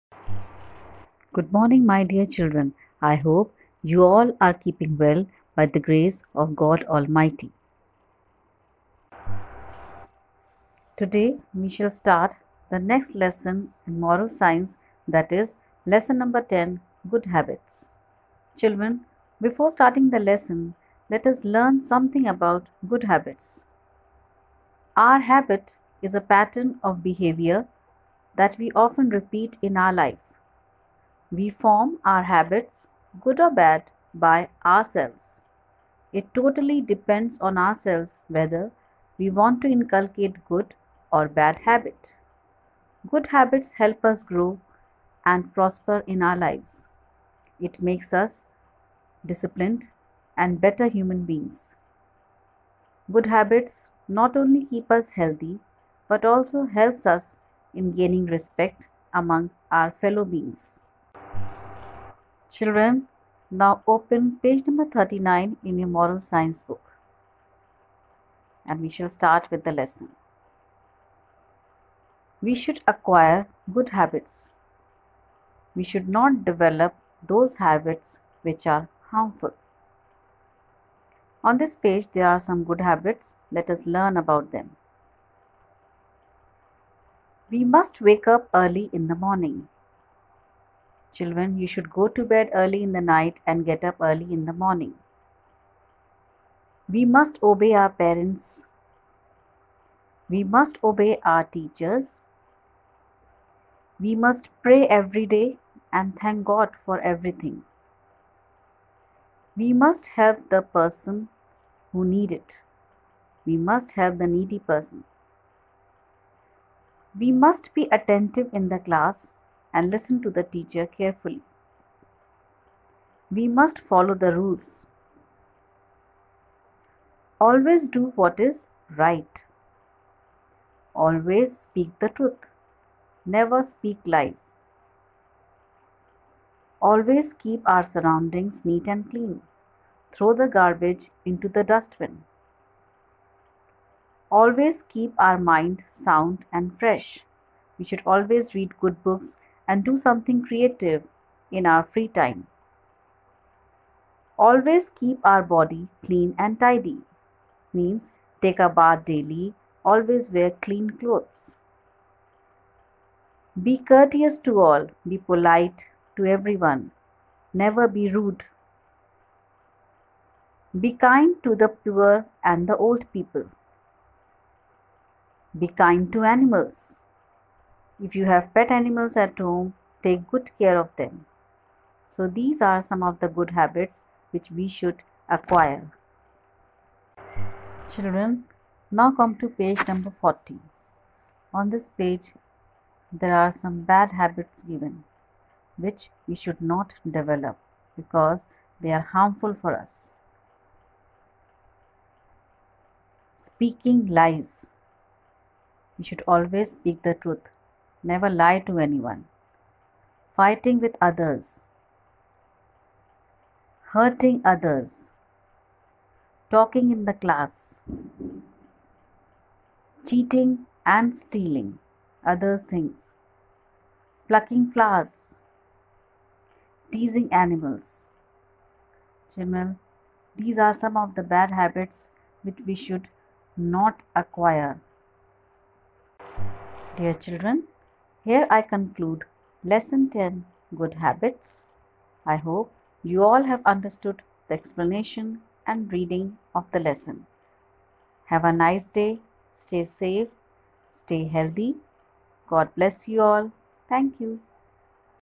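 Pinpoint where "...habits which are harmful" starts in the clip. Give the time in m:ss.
1:17.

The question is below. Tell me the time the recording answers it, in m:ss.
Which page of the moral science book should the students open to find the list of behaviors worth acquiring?
1:04.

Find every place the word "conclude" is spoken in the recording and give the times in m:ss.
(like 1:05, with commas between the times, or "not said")
3:58.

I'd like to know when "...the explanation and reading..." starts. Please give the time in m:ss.
4:04.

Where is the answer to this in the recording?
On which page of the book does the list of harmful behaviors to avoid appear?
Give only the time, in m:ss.
3:09.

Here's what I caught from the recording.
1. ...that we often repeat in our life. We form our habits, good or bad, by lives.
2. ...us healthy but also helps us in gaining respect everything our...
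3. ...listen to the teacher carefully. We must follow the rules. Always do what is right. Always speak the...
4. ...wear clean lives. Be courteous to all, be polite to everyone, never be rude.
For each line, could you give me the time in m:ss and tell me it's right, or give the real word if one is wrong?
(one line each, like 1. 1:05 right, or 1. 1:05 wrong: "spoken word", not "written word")
1. 0:28 wrong: "ourselves", not "lives"
2. 0:54 wrong: "among", not "everything"
3. 1:59 right
4. 2:40 wrong: "clothes", not "lives".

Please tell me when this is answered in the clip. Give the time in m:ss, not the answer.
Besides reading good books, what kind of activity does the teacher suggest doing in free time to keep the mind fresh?
2:30.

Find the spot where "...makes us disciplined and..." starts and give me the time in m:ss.
0:47.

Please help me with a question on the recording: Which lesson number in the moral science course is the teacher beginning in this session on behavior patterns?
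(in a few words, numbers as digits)
10.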